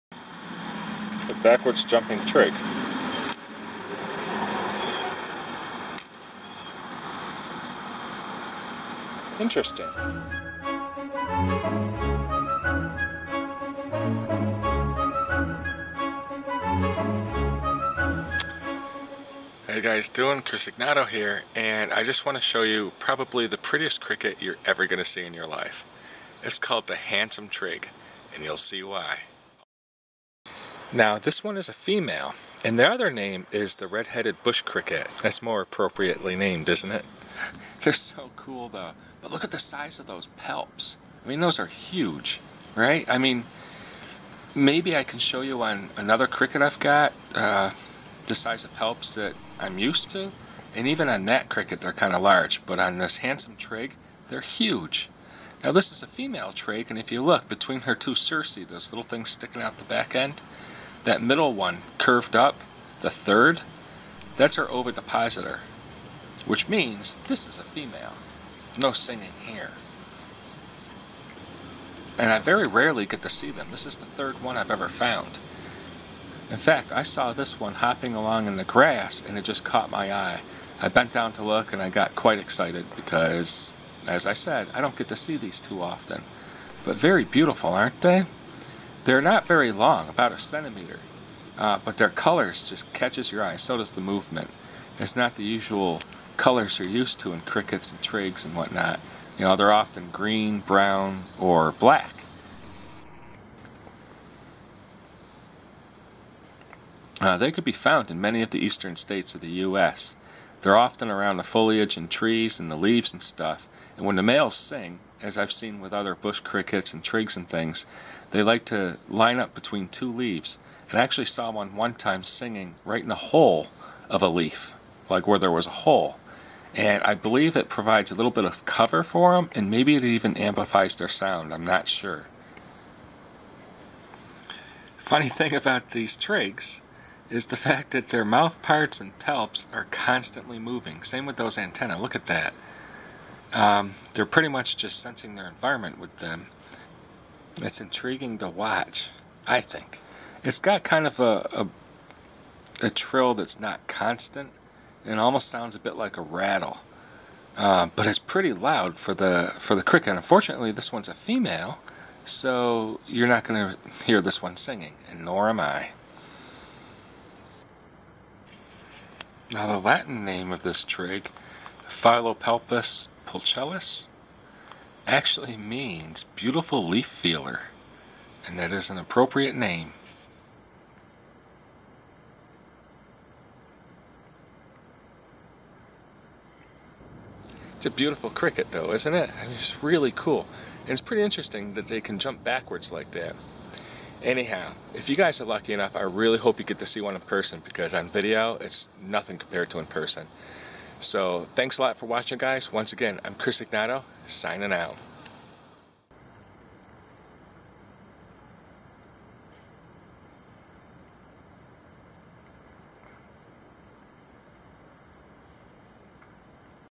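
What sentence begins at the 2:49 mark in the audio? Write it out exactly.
Now, the Latin name of this trig, Phyllopalpus pulchellus, actually means beautiful leaf feeler, and that is an appropriate name.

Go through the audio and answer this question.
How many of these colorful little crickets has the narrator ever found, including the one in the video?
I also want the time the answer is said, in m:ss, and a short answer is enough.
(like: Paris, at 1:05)
3, at 1:13.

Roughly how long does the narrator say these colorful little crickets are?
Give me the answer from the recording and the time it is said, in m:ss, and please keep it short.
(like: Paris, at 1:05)
about a centimeter, at 1:30.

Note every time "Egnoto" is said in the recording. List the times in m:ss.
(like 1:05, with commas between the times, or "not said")
0:20, 3:23.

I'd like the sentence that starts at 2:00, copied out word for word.
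And I actually saw one one time singing right in the hole of a leaf, like where there was a hole.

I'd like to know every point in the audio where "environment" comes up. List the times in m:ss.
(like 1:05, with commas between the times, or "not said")
2:25.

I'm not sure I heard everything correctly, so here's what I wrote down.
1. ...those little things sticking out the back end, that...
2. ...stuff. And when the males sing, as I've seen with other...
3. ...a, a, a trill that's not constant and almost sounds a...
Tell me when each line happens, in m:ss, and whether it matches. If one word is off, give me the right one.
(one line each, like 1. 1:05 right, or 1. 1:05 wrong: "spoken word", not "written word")
1. 0:58 right
2. 1:53 right
3. 2:31 right.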